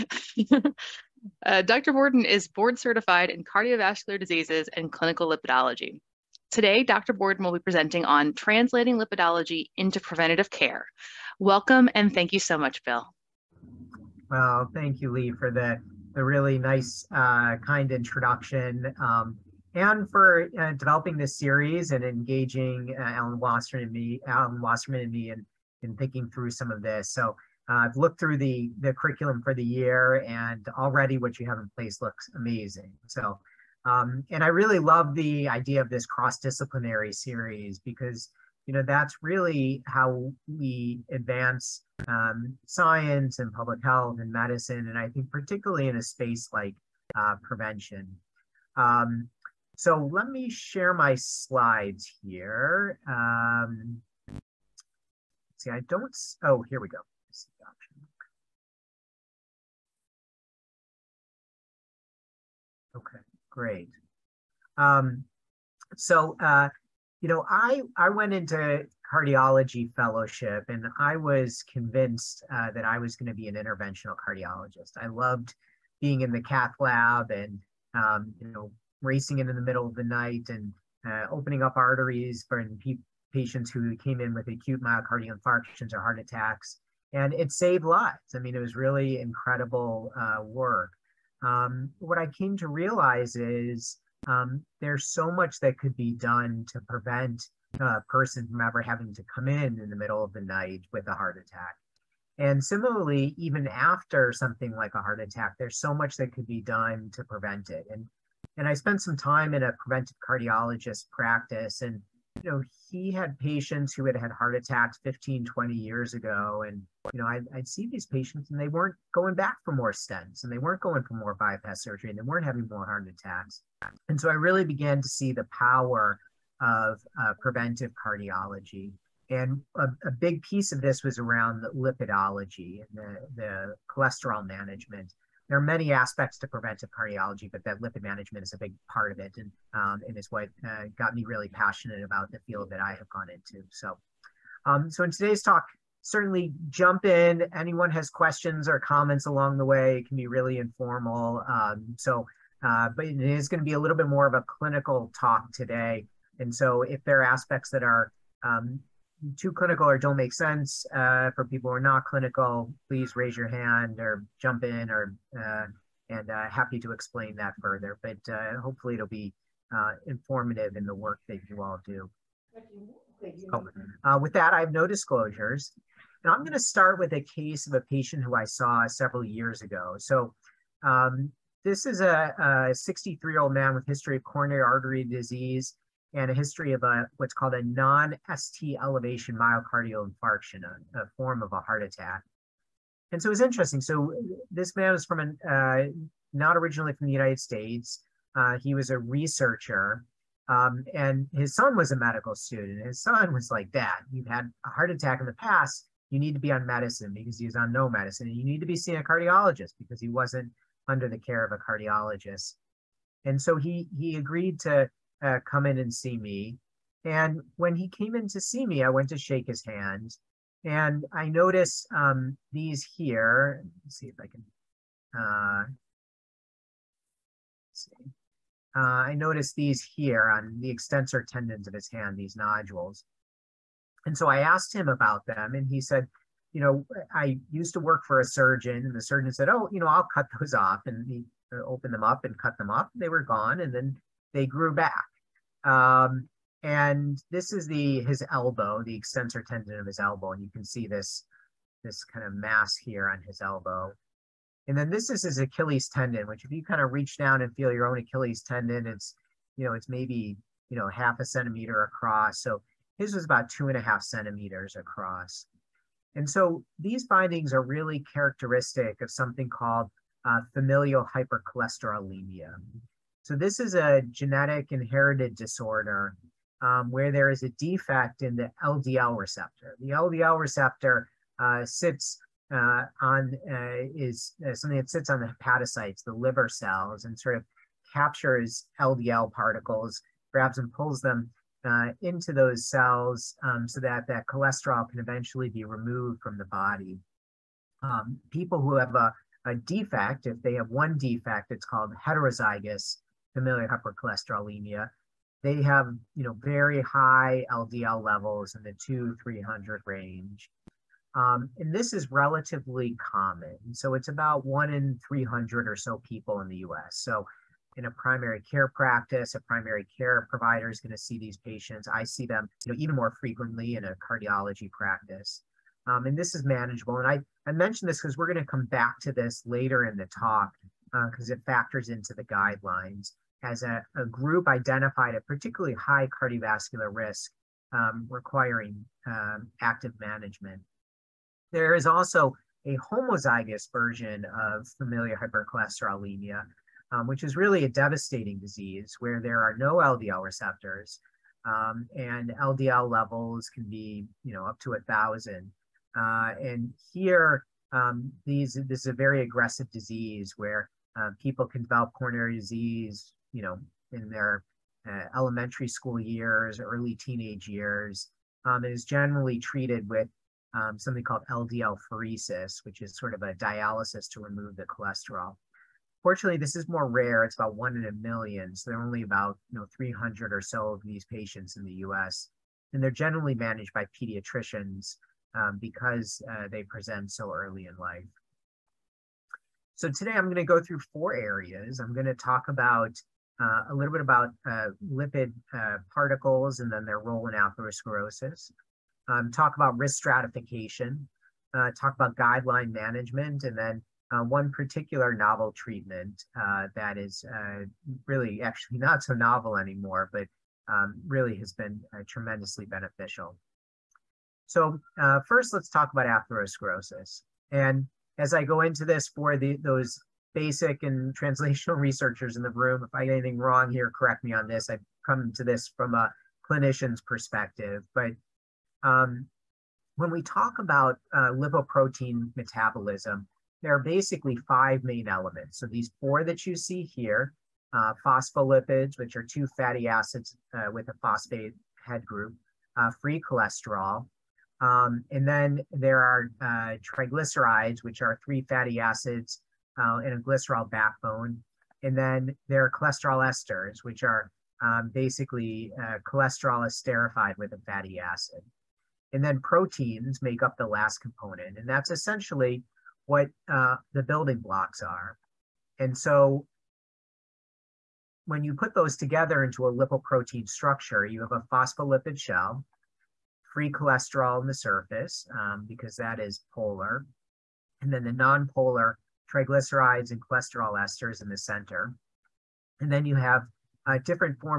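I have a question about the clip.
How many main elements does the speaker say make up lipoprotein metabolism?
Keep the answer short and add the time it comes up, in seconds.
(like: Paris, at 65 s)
5, at 434 s.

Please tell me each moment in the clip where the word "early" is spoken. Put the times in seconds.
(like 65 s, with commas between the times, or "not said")
366 s, 387 s.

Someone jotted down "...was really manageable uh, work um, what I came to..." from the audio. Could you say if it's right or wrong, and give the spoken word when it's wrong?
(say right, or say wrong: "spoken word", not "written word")
wrong: "incredible", not "manageable".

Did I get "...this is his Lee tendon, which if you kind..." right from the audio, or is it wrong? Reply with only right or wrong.
wrong.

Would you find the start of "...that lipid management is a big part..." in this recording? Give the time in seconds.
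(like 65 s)
137 s.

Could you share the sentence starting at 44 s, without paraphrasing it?
And I think particularly in a space like uh, prevention.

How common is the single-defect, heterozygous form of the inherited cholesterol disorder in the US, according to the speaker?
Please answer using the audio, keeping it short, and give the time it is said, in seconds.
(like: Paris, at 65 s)
1 in 300, at 314 s.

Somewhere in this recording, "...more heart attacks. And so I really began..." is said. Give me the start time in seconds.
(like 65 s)
122 s.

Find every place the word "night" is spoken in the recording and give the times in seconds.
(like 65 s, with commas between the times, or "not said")
80 s, 100 s.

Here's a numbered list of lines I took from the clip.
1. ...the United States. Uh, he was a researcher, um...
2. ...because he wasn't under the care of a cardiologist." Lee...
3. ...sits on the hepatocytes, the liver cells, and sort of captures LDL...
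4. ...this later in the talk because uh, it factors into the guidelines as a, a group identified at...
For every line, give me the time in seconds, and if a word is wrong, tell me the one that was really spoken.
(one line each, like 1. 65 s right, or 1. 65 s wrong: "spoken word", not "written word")
1. 197 s right
2. 209 s wrong: "And", not "Lee"
3. 284 s right
4. 329 s right.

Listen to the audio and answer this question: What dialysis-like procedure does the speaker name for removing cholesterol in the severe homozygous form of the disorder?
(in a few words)
LDL pheresis.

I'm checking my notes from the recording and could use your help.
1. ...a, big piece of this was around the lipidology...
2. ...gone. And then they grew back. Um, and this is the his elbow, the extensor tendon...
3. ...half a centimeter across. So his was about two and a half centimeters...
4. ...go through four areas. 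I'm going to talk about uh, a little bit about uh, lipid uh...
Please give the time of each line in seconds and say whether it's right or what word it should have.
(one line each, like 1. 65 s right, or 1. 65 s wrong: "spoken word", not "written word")
1. 130 s right
2. 243 s right
3. 260 s right
4. 390 s right.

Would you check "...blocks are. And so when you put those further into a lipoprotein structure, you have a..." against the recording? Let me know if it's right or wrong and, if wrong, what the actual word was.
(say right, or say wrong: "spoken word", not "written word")
wrong: "together", not "further".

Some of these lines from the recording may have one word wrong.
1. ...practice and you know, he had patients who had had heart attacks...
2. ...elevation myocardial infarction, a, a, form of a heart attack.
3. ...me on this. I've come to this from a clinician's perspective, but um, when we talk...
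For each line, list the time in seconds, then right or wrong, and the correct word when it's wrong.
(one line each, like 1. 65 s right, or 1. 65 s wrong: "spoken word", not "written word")
1. 111 s right
2. 188 s right
3. 424 s right.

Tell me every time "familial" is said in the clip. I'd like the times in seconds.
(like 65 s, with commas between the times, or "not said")
270 s, 303 s, 344 s.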